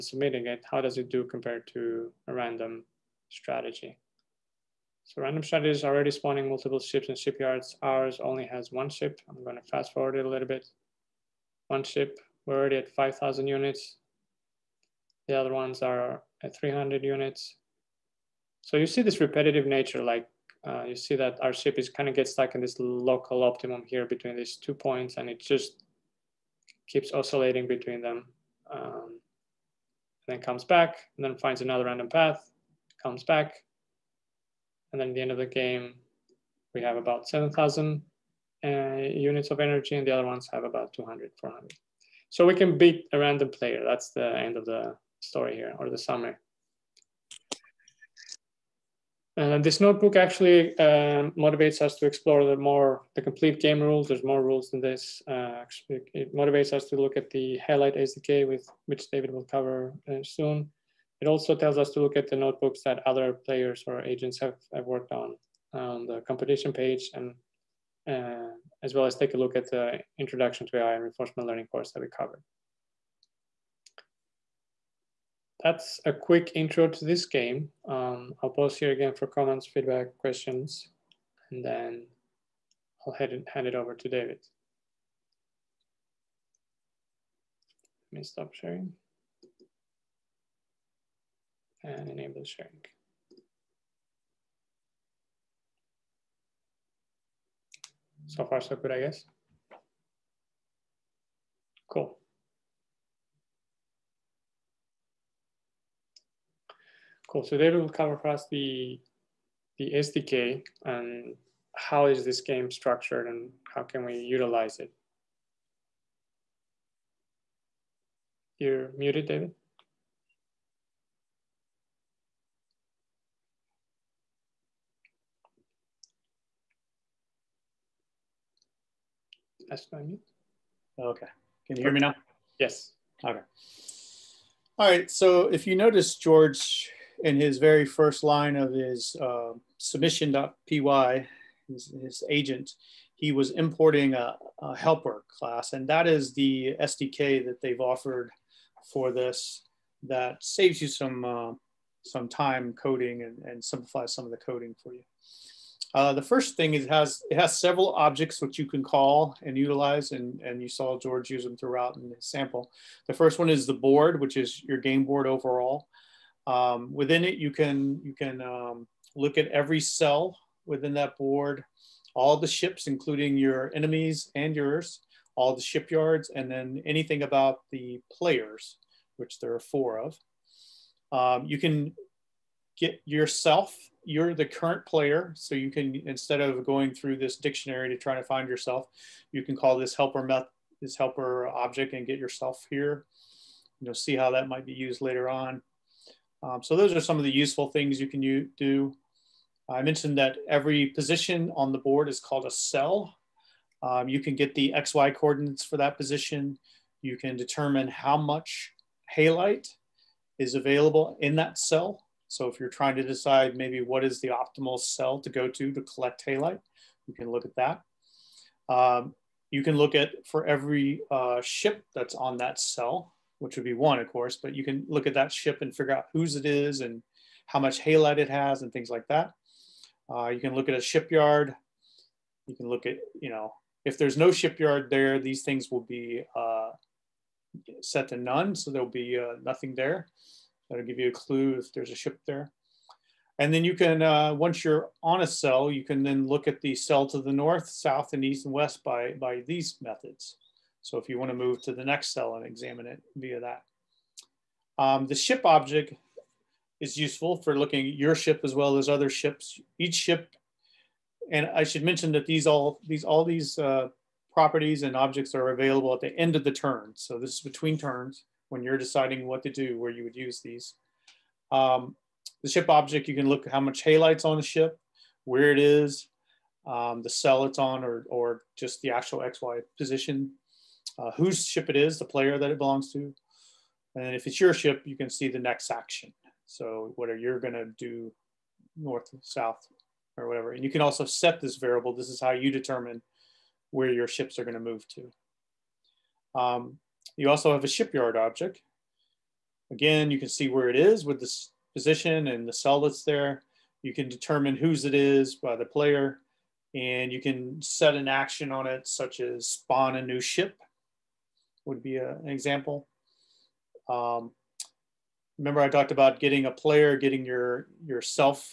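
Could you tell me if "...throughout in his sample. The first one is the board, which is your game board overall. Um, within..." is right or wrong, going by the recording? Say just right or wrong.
right.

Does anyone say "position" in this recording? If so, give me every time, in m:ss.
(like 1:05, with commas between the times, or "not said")
3:20, 3:25, 4:39, 5:01.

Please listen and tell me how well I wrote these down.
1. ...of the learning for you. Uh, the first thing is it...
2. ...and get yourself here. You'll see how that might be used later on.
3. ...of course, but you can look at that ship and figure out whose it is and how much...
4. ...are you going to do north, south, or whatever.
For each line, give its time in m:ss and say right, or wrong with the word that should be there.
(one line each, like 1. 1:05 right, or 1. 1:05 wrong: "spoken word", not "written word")
1. 2:34 wrong: "coding", not "learning"
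2. 3:11 right
3. 3:43 right
4. 4:47 right.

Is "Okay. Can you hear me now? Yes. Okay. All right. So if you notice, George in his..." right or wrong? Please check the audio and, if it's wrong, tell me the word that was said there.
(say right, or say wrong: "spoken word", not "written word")
right.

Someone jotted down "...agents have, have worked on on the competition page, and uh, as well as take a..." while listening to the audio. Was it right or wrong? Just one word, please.
right.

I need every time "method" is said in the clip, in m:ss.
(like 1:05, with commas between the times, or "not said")
3:10, 4:09.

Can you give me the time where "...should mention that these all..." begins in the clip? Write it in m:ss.
4:21.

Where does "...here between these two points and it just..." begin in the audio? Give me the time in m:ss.
0:23.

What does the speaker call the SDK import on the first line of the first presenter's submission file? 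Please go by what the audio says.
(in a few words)
helper class.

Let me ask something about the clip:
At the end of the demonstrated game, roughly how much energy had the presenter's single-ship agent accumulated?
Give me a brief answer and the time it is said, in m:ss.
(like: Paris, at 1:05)
7,000, at 0:37.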